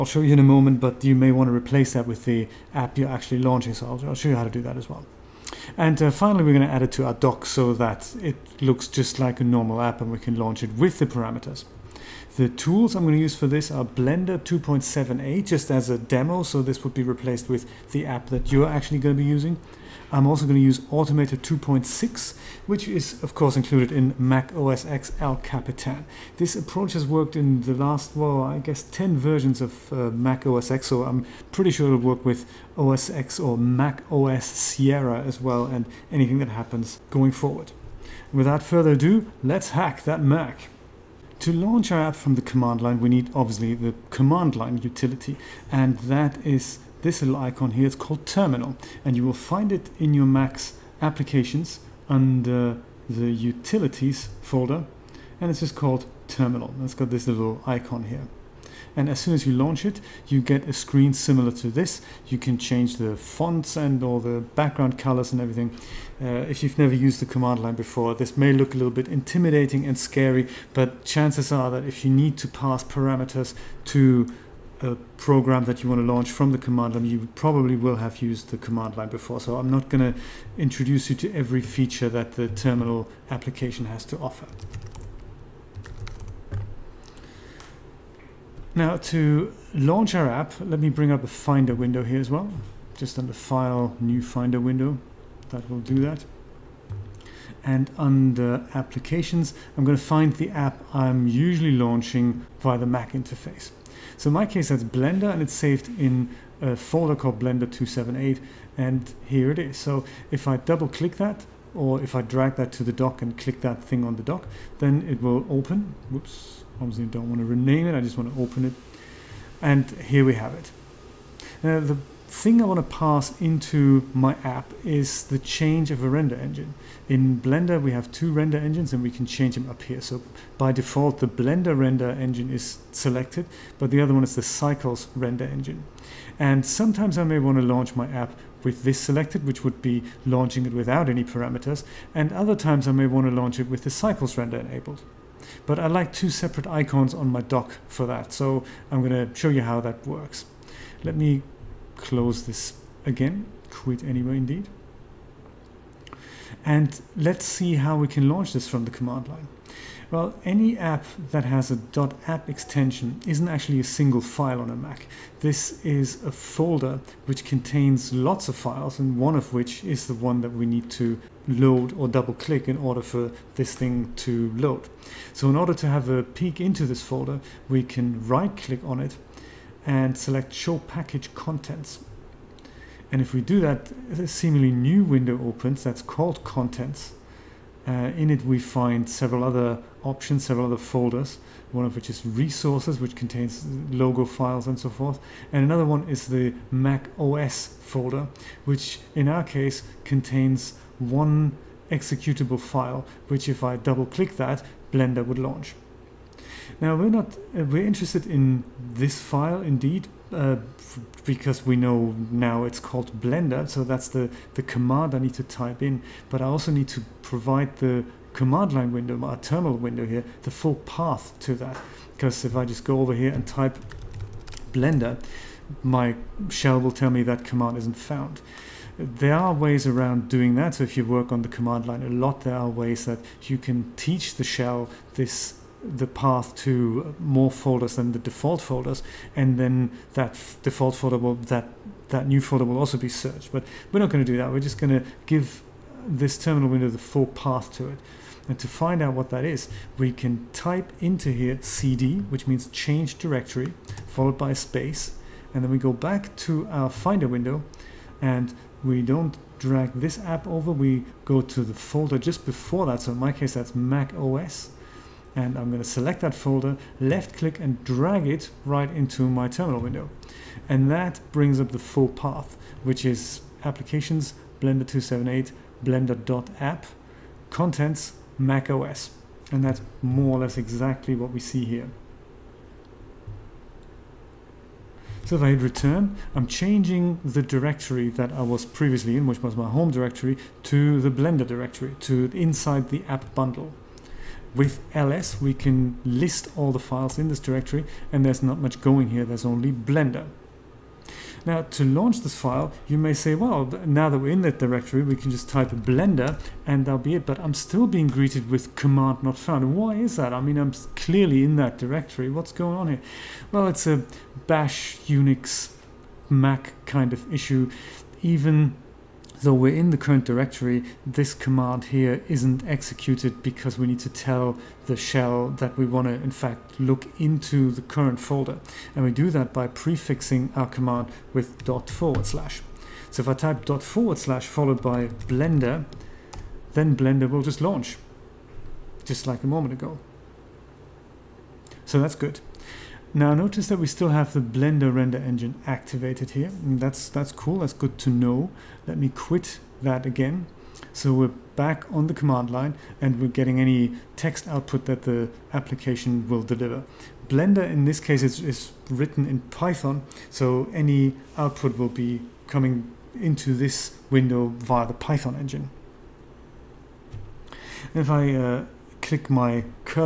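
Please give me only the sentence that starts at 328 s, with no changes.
And we do that by prefixing our command with dot forward slash.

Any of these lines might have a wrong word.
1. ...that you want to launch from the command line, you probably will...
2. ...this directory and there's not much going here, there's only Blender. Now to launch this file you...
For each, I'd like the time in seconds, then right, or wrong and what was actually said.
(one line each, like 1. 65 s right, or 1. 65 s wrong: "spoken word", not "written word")
1. 75 s right
2. 297 s right.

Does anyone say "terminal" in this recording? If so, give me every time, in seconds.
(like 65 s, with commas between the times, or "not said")
48 s, 56 s, 82 s, 219 s, 246 s, 269 s.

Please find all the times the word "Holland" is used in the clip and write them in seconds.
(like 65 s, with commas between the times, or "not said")
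not said.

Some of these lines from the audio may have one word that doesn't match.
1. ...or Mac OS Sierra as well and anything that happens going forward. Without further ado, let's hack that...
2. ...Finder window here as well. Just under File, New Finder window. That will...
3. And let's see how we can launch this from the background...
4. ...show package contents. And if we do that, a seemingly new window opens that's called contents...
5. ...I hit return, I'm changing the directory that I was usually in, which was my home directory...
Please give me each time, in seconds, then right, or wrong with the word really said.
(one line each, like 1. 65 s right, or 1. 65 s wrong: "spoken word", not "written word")
1. 33 s right
2. 91 s right
3. 156 s wrong: "command", not "background"
4. 180 s right
5. 285 s wrong: "previously", not "usually".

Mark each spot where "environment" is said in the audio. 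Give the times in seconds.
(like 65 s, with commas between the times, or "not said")
not said.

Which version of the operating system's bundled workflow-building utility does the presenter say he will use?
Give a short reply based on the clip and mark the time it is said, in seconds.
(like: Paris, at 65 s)
2.6, at 20 s.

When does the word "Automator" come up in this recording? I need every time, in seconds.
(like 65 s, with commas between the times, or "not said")
20 s.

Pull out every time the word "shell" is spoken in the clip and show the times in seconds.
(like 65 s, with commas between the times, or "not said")
226 s, 234 s, 324 s.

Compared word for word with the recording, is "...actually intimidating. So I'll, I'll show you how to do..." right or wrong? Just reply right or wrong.
wrong.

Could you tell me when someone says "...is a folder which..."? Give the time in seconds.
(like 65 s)
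165 s.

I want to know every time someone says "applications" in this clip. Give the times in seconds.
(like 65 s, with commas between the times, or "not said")
51 s, 83 s, 98 s, 273 s, 355 s.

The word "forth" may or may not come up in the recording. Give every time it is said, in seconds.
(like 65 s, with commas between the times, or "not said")
194 s.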